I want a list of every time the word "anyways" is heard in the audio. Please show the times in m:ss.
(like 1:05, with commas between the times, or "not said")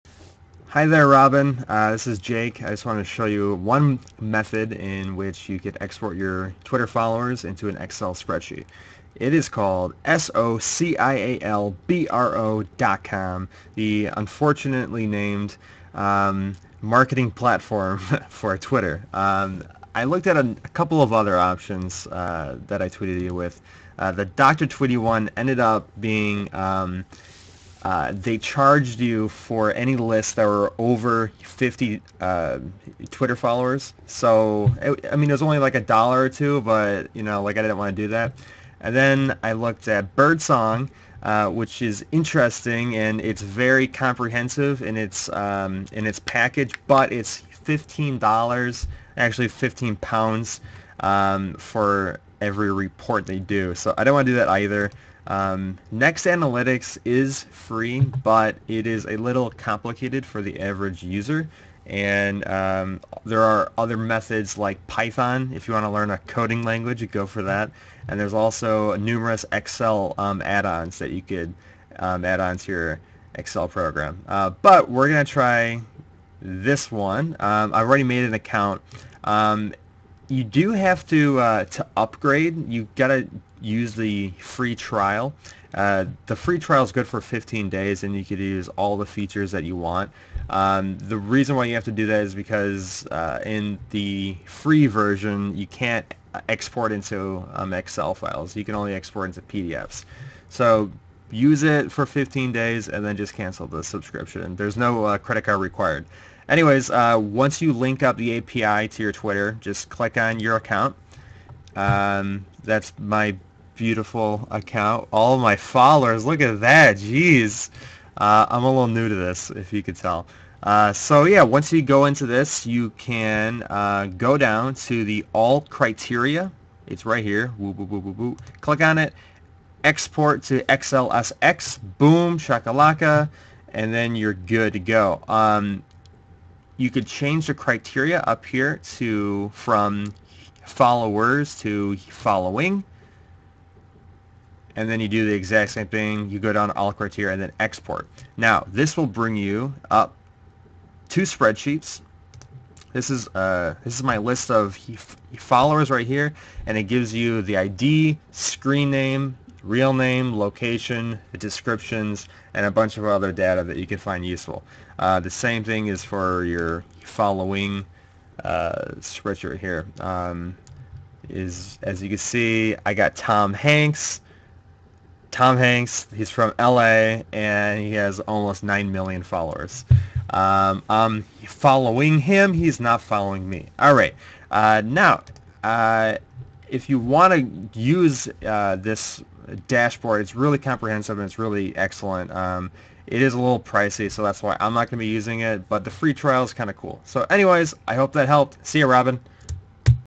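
1:46, 3:17.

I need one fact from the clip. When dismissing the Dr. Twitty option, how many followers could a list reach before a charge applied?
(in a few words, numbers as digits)
50.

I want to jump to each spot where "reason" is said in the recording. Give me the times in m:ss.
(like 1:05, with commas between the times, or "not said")
1:31.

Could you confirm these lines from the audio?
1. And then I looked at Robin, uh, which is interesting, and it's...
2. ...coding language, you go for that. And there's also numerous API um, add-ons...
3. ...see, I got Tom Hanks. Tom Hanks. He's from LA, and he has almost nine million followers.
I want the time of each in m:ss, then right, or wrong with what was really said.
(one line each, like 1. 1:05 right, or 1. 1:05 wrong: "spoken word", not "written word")
1. 0:38 wrong: "Birdsong", not "Robin"
2. 1:06 wrong: "Excel", not "API"
3. 2:52 right.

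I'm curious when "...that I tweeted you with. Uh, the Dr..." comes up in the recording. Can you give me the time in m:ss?
0:22.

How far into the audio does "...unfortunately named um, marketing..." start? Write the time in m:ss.
0:14.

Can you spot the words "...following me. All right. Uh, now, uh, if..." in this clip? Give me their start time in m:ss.
3:03.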